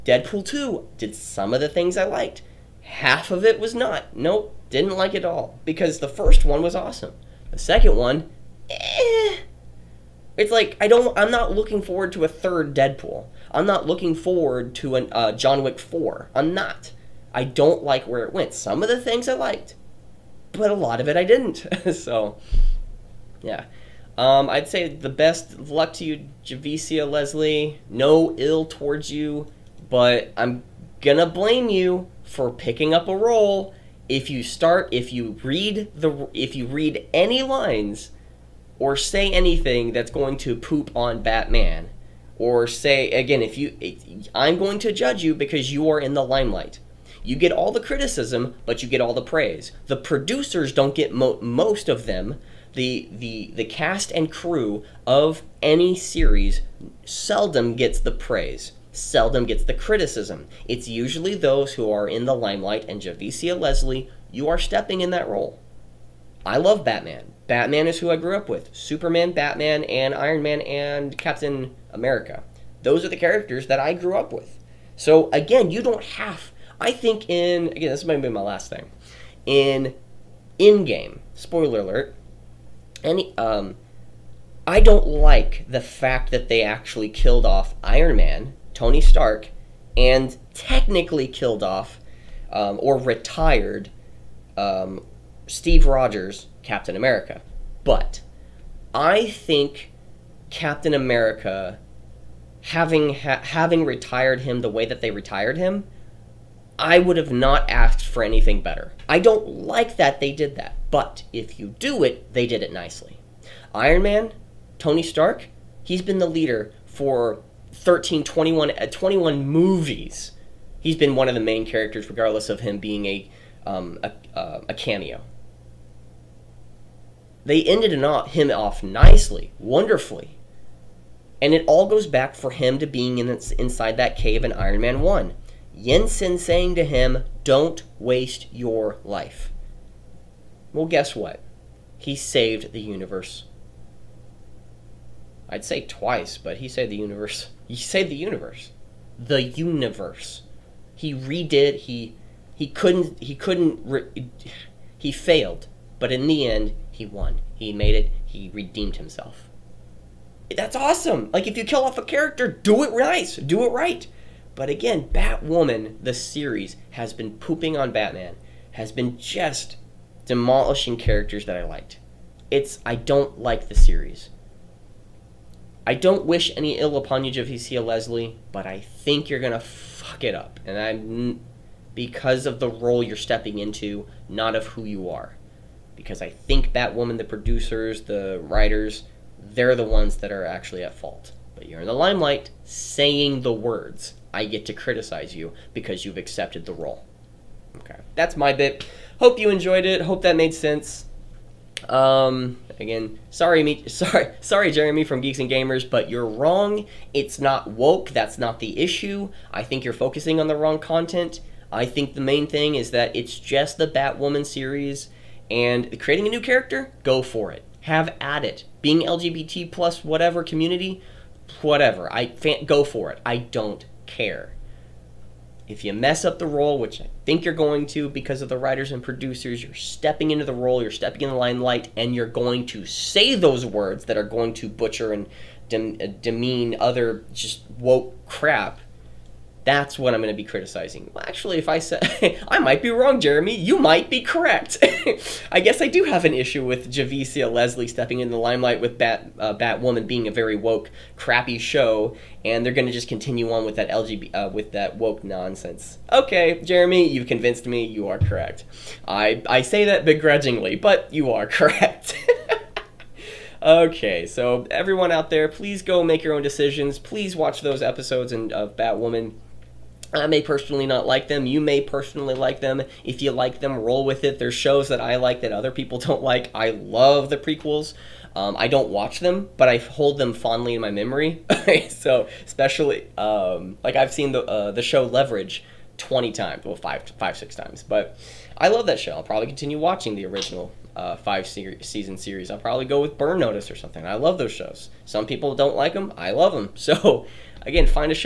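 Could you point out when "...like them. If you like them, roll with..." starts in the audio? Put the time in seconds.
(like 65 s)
272 s.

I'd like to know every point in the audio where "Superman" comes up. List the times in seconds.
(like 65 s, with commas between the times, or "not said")
68 s.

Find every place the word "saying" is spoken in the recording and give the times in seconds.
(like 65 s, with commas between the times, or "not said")
136 s, 192 s.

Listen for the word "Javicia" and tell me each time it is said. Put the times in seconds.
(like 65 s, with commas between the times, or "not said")
26 s, 63 s, 177 s, 246 s.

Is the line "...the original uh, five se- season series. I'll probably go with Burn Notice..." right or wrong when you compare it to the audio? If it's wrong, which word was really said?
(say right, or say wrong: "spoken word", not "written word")
right.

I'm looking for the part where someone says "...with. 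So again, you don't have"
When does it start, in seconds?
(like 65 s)
74 s.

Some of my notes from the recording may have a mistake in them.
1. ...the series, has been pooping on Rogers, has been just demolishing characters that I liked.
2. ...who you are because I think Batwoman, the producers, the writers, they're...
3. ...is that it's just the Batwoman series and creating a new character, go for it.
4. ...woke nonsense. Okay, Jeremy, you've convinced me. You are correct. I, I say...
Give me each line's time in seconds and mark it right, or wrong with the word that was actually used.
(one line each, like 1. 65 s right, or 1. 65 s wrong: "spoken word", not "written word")
1. 166 s wrong: "Batman", not "Rogers"
2. 184 s right
3. 212 s right
4. 254 s right.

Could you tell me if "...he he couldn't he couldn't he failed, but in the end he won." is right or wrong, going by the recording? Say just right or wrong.
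right.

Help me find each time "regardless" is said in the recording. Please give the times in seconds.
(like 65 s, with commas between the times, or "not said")
122 s.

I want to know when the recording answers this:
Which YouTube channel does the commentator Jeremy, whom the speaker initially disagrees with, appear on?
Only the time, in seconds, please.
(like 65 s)
205 s.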